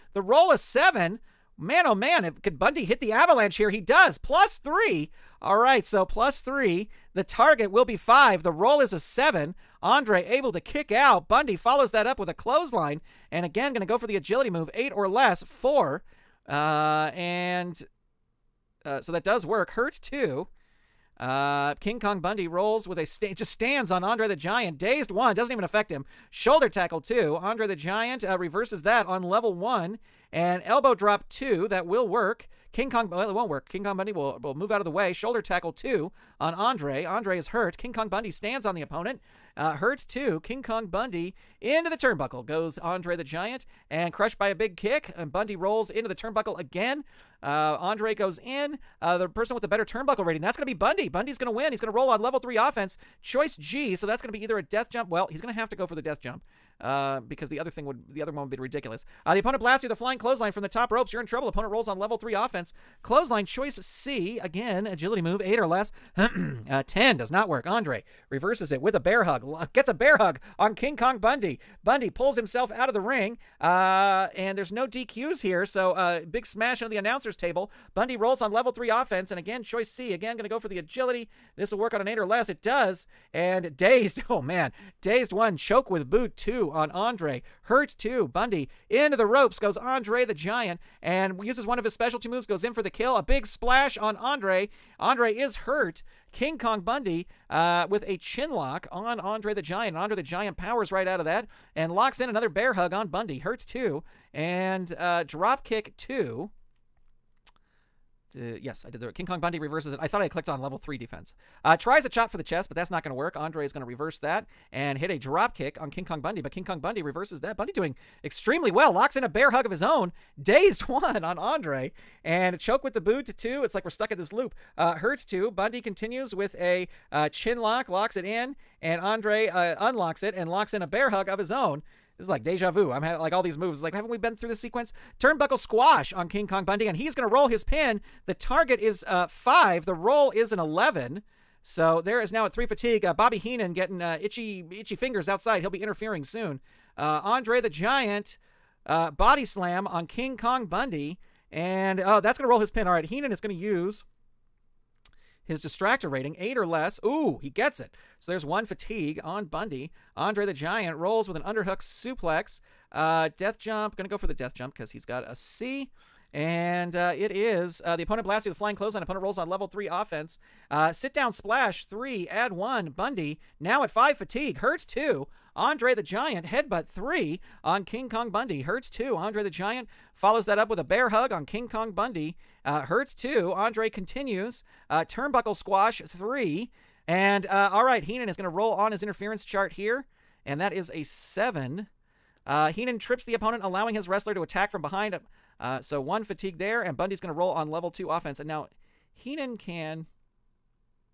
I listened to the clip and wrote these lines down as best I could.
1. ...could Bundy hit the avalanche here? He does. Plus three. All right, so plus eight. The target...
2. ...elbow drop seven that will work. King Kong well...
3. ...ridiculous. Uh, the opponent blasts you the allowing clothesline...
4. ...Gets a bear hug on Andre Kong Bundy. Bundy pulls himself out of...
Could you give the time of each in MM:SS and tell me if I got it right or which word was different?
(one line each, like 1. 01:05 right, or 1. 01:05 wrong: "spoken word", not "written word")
1. 00:02 wrong: "three", not "eight"
2. 00:30 wrong: "two", not "seven"
3. 00:58 wrong: "flying", not "allowing"
4. 01:09 wrong: "King", not "Andre".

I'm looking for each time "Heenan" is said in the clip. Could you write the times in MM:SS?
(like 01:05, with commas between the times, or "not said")
02:23, 02:33, 03:08, 03:12, 03:19.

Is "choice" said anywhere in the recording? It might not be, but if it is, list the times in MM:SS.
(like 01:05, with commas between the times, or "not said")
00:53, 01:03, 01:19.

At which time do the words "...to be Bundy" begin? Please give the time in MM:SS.
00:50.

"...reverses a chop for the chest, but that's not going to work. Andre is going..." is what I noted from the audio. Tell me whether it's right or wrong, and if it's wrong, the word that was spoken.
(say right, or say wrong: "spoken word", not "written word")
wrong: "tries", not "reverses".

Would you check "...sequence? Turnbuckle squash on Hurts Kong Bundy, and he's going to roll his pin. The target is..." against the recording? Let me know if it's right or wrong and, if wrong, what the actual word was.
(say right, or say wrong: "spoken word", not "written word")
wrong: "King", not "Hurts".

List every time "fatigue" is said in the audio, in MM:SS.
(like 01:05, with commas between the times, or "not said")
02:22, 02:38, 02:54, 03:16.